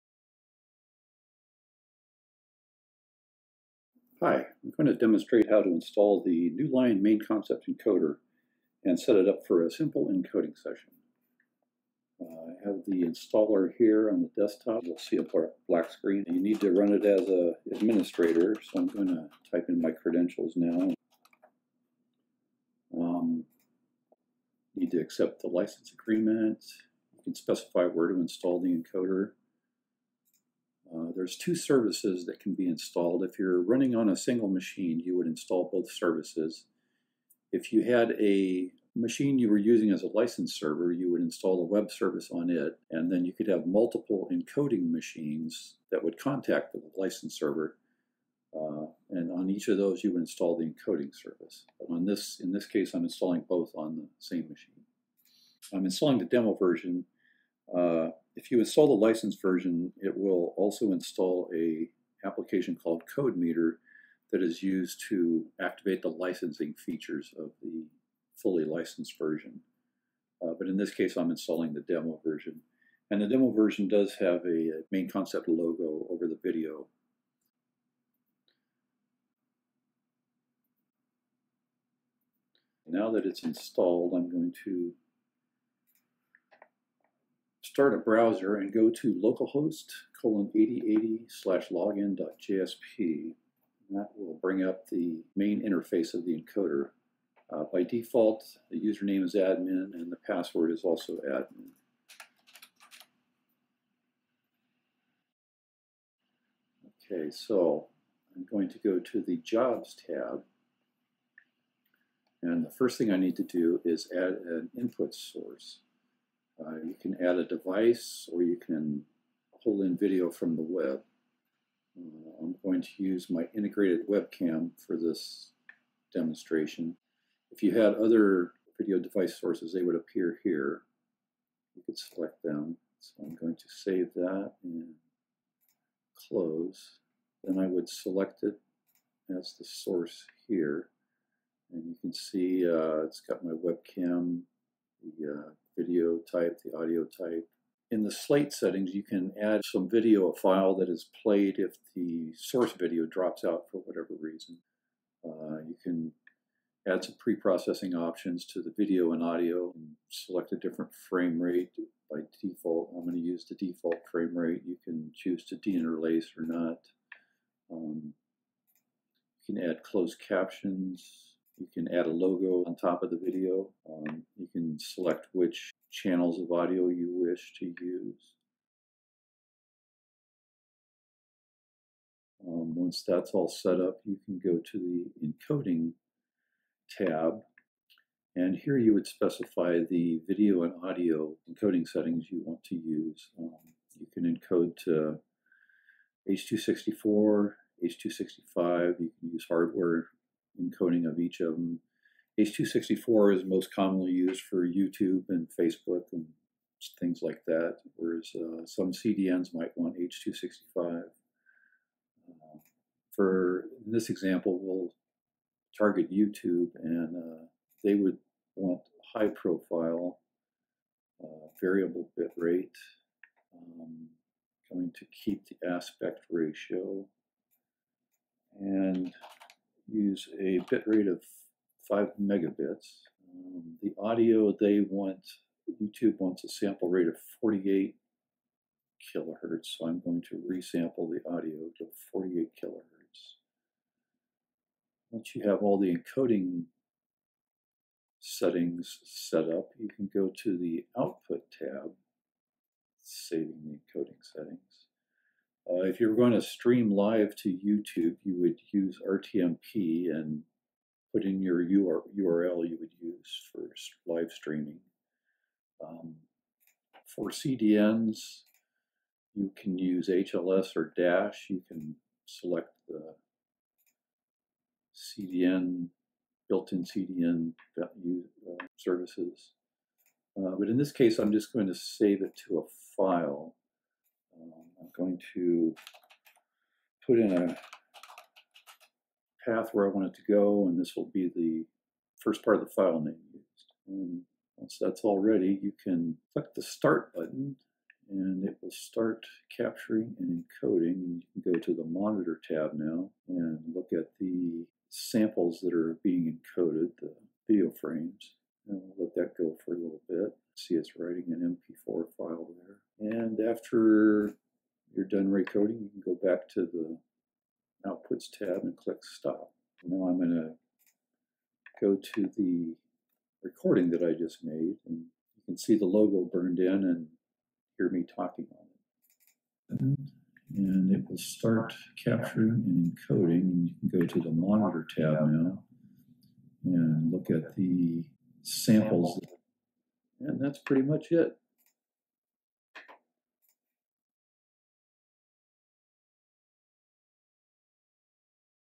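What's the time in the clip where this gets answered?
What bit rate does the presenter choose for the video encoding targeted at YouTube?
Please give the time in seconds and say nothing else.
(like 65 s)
231 s.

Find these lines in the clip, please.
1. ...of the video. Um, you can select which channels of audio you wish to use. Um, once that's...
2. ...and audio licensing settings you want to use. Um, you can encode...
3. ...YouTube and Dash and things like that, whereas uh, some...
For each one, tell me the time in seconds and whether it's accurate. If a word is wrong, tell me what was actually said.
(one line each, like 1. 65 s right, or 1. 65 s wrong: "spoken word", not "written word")
1. 173 s right
2. 190 s wrong: "encoding", not "licensing"
3. 204 s wrong: "Facebook", not "Dash".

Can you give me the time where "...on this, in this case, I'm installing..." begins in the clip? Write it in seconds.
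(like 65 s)
51 s.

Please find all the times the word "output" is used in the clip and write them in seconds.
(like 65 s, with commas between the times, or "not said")
250 s, 317 s.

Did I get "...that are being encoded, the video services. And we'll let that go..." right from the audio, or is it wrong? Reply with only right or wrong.
wrong.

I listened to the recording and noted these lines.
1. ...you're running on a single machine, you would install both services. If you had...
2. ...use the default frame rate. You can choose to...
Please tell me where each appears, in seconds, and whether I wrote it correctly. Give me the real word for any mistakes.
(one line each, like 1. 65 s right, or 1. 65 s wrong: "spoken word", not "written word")
1. 33 s right
2. 163 s right.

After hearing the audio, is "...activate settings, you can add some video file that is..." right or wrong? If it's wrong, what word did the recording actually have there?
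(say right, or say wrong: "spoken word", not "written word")
wrong: "slate", not "activate".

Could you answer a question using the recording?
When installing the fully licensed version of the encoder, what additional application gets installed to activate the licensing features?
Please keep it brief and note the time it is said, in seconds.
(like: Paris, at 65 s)
CodeMeter, at 63 s.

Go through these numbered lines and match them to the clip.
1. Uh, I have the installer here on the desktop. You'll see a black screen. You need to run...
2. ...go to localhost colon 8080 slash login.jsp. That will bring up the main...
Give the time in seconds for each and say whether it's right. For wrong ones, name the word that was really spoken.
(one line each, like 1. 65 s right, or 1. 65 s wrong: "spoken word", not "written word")
1. 12 s right
2. 88 s right.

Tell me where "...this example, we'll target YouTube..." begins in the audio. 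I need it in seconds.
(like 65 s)
213 s.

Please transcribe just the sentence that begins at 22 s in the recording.
Um, need to accept the license agreement.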